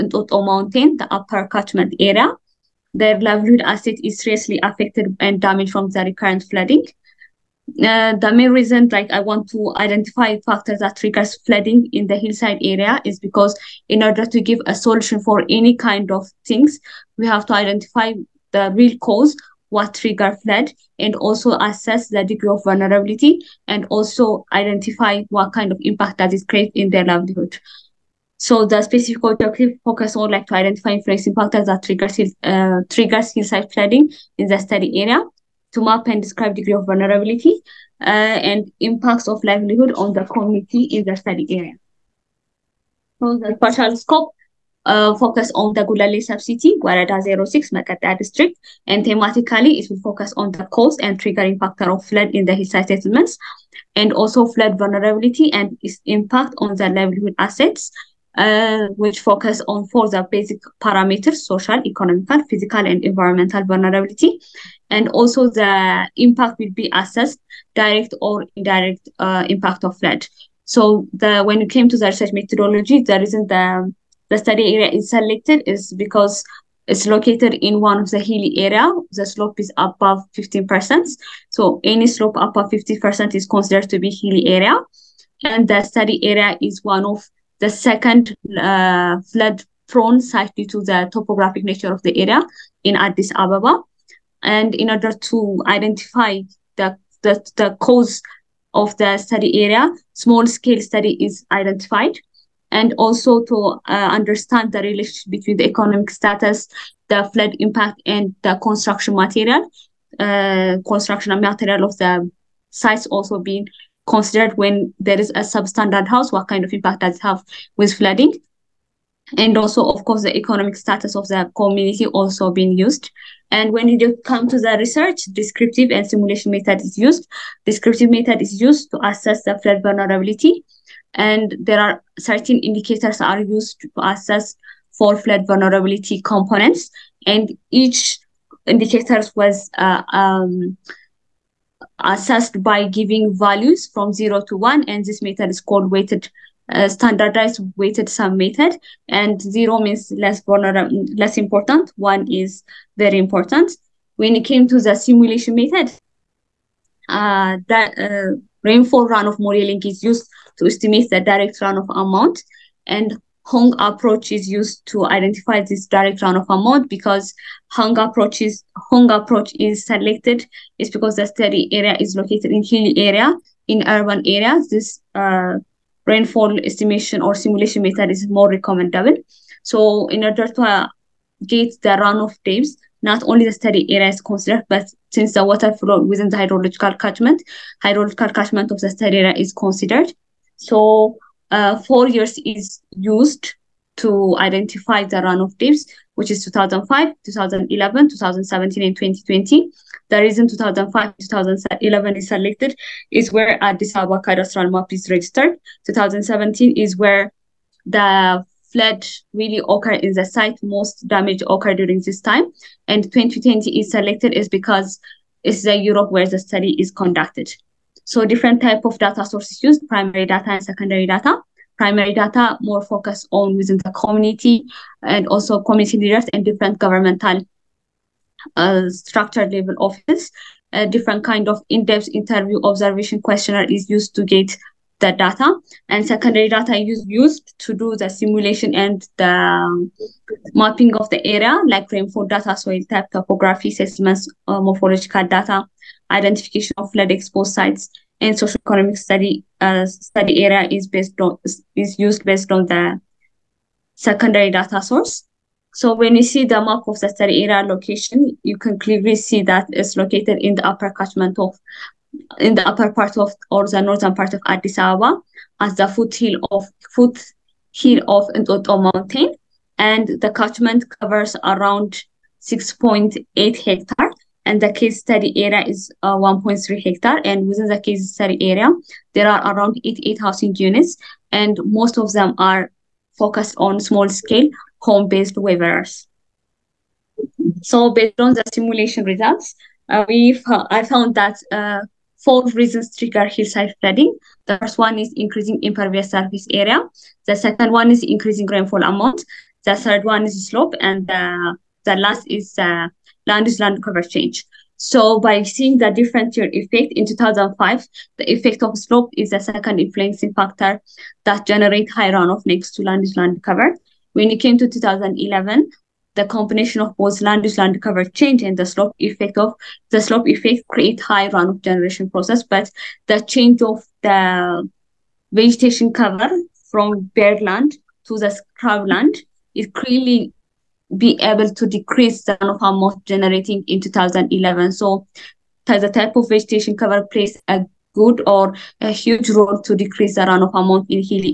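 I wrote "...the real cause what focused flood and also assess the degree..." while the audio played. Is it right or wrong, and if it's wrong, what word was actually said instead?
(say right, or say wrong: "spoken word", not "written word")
wrong: "triggered", not "focused".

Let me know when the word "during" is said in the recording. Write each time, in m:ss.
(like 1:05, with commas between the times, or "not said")
3:31.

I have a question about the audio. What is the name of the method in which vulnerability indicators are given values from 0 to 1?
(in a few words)
Standardized weighted sum method.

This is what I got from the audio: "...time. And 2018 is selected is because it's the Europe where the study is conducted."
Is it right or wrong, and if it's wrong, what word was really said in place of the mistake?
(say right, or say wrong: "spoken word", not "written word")
wrong: "2020", not "2018".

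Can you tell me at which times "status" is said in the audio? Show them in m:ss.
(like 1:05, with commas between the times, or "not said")
1:46, 2:00.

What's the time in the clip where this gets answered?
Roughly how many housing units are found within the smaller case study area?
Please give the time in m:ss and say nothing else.
4:39.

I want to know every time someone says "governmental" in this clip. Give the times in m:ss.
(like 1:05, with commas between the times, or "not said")
3:46.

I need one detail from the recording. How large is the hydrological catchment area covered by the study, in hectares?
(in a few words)
6.8 hectares.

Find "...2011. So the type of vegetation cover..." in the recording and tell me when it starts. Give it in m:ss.
5:33.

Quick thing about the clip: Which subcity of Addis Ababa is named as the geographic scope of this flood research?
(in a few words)
Gullele.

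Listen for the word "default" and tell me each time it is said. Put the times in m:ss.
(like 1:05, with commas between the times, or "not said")
not said.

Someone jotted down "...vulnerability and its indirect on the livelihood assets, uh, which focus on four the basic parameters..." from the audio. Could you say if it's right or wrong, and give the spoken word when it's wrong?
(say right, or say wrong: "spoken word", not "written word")
wrong: "impact", not "indirect".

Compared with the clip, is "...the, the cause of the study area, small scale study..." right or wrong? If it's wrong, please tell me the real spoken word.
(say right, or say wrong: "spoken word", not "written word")
right.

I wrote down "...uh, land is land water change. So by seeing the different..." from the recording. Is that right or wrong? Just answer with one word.
wrong.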